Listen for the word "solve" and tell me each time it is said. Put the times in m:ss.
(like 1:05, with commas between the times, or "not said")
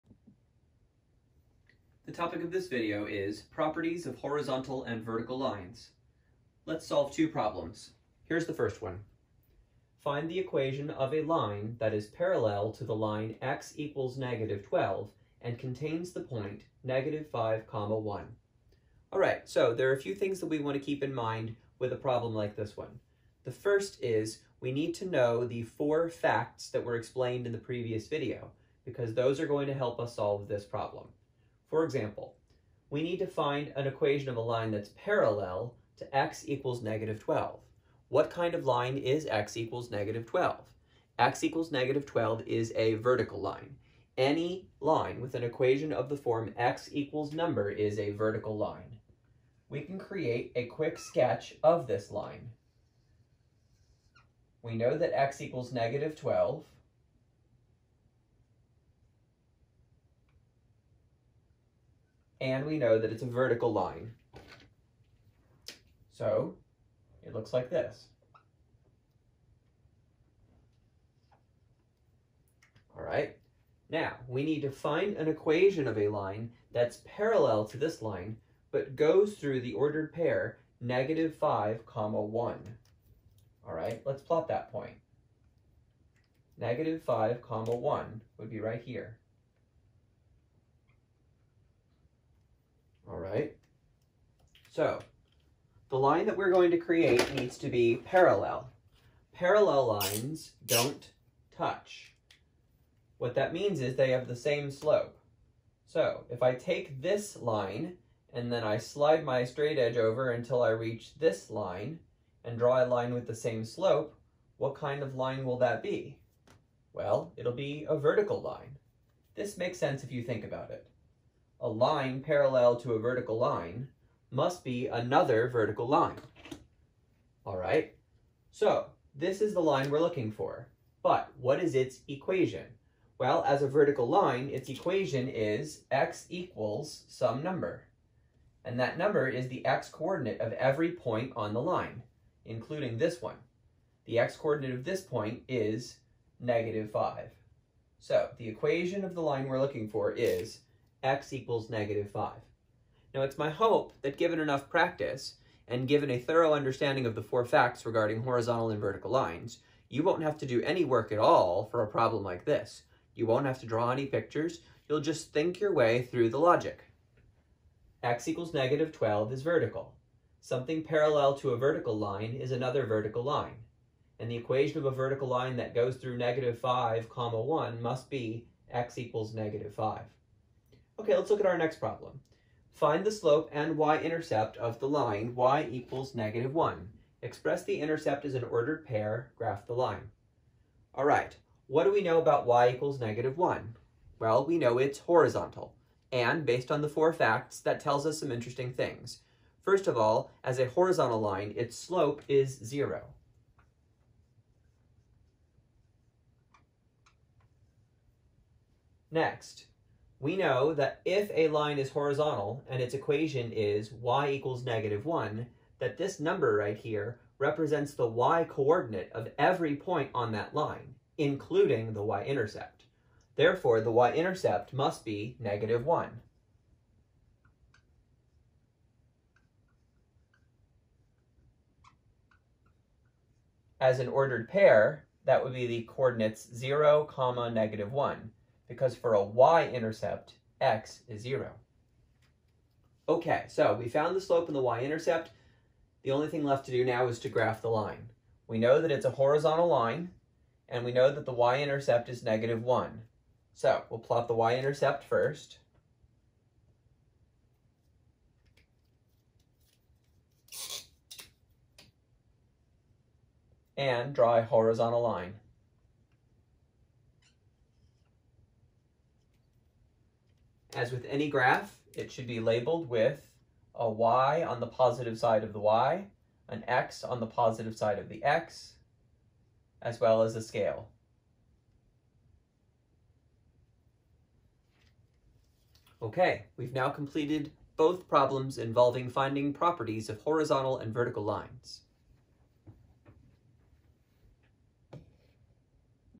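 0:06, 0:30.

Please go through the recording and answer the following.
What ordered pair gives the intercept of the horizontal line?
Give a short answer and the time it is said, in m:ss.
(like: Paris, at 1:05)
(0, -1), at 3:56.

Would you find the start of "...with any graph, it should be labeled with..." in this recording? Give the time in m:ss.
4:30.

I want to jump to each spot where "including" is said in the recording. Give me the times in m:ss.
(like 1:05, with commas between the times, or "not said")
2:22, 3:41.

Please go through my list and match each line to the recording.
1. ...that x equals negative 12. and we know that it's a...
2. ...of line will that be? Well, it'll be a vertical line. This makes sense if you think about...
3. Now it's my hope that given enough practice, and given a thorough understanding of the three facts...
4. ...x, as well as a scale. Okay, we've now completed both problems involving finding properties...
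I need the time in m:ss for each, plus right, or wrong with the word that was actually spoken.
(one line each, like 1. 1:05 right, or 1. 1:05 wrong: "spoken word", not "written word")
1. 0:54 right
2. 1:55 right
3. 2:33 wrong: "four", not "three"
4. 4:38 right.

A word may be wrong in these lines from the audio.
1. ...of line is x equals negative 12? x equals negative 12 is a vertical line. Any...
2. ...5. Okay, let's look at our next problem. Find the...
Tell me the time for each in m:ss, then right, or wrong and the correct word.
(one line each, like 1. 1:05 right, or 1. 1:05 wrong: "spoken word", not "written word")
1. 0:38 right
2. 2:59 right.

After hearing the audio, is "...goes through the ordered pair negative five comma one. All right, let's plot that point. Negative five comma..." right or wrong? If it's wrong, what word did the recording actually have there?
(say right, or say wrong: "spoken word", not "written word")
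right.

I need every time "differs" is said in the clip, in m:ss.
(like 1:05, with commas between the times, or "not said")
not said.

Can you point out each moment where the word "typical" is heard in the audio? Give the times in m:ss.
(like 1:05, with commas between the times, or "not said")
not said.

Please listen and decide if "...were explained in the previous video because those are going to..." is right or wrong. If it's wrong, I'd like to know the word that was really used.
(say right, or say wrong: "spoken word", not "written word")
right.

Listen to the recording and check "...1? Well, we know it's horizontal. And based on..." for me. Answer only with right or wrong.
right.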